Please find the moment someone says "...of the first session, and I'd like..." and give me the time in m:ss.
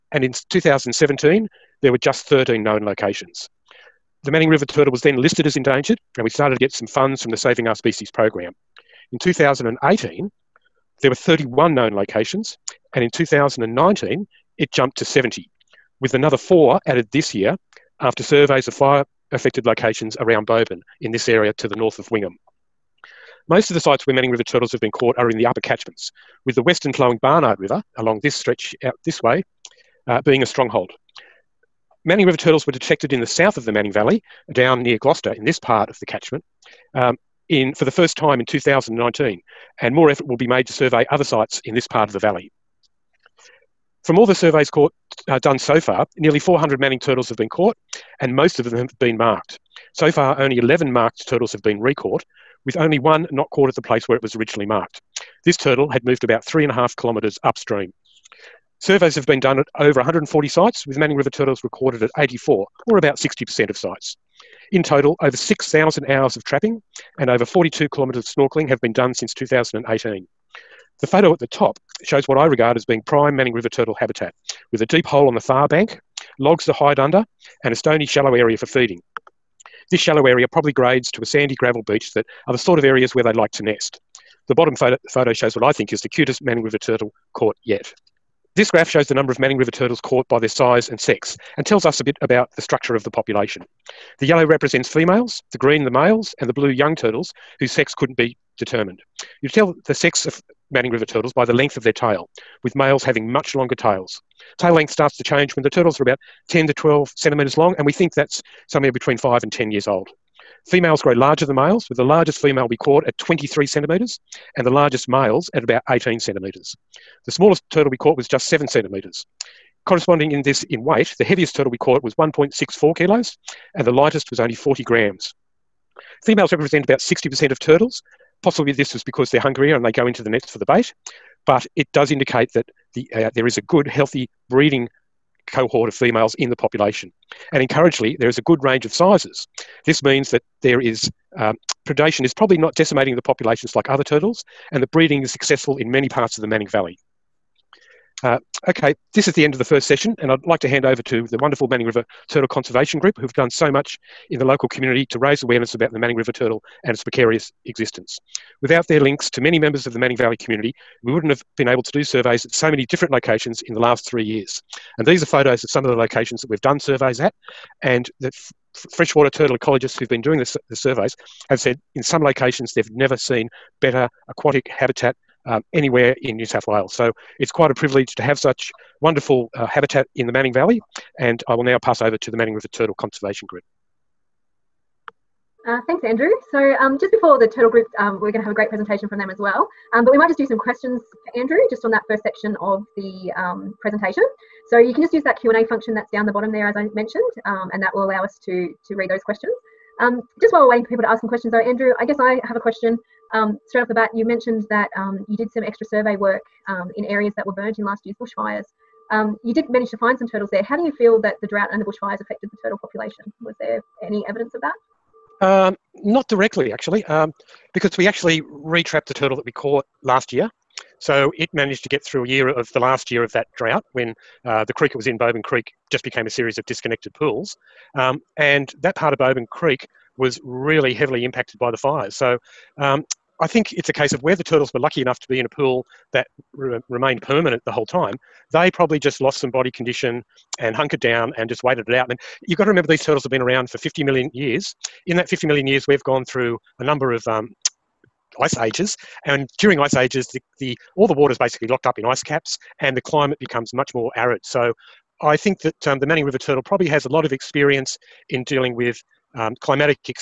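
2:29.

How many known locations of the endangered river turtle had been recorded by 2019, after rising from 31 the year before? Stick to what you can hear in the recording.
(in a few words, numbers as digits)
70.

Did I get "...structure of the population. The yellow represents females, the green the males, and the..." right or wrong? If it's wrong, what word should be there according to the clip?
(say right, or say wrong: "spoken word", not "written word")
right.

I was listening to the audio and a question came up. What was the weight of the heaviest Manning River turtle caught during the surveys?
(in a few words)
1.64 kilos.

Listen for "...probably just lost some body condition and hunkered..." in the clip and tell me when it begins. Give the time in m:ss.
3:58.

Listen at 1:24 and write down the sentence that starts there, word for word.
The bottom photo, photo shows what I think is the cutest Manning River turtle caught yet.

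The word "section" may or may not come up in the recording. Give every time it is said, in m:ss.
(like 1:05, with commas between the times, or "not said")
3:12.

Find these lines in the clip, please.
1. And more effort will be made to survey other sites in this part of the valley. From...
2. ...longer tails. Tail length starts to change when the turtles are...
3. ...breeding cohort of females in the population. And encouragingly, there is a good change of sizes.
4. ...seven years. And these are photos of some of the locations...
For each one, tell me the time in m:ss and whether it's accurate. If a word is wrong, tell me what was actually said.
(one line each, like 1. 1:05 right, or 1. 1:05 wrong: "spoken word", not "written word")
1. 0:39 right
2. 1:43 right
3. 2:14 wrong: "range", not "change"
4. 2:44 wrong: "three", not "seven".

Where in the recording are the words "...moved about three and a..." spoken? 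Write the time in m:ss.
0:56.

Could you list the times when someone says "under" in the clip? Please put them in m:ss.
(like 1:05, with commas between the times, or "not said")
1:16.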